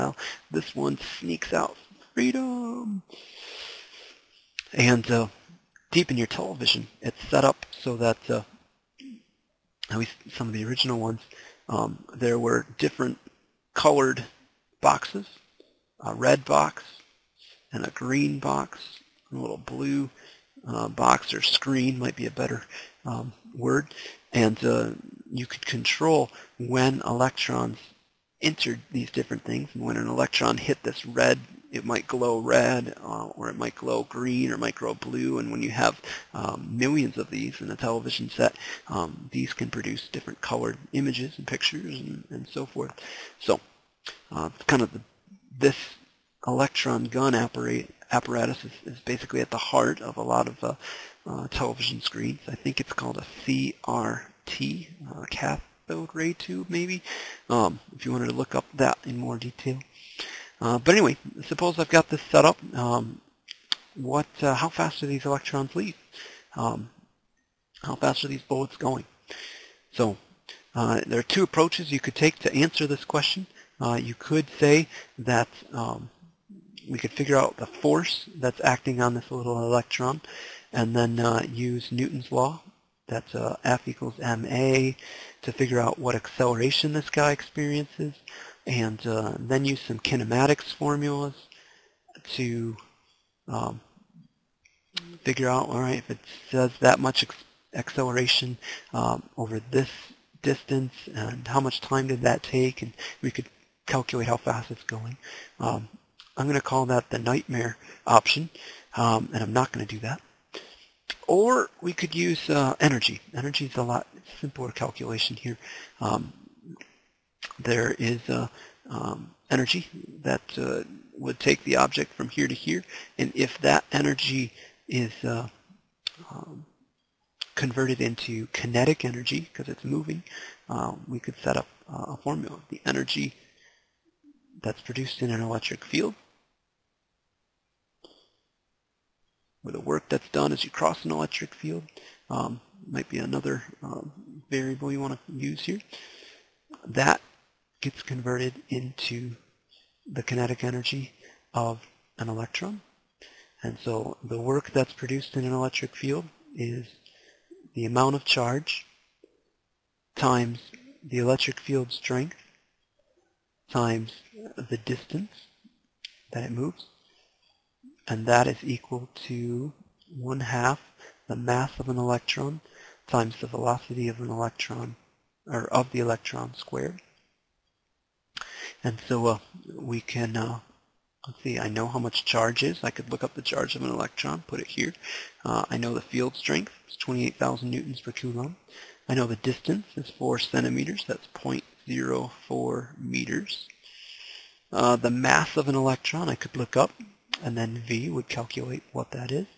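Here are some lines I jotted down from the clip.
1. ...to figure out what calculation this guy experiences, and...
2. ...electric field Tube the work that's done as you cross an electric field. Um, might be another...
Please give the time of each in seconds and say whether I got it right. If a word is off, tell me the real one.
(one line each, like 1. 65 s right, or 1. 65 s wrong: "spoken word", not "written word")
1. 85 s wrong: "acceleration", not "calculation"
2. 135 s wrong: "With", not "Tube".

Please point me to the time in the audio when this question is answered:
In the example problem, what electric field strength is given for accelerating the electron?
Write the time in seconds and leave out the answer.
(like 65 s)
186 s.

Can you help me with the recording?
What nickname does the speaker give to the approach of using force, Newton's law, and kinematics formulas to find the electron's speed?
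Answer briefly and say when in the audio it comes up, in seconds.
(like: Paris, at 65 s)
the nightmare option, at 107 s.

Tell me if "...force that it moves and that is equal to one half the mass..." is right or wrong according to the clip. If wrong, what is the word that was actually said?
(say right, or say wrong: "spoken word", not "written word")
wrong: "distance", not "force".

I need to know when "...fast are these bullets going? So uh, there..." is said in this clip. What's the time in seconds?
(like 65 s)
67 s.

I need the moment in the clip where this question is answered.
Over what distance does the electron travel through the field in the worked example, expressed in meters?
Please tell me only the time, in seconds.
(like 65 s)
191 s.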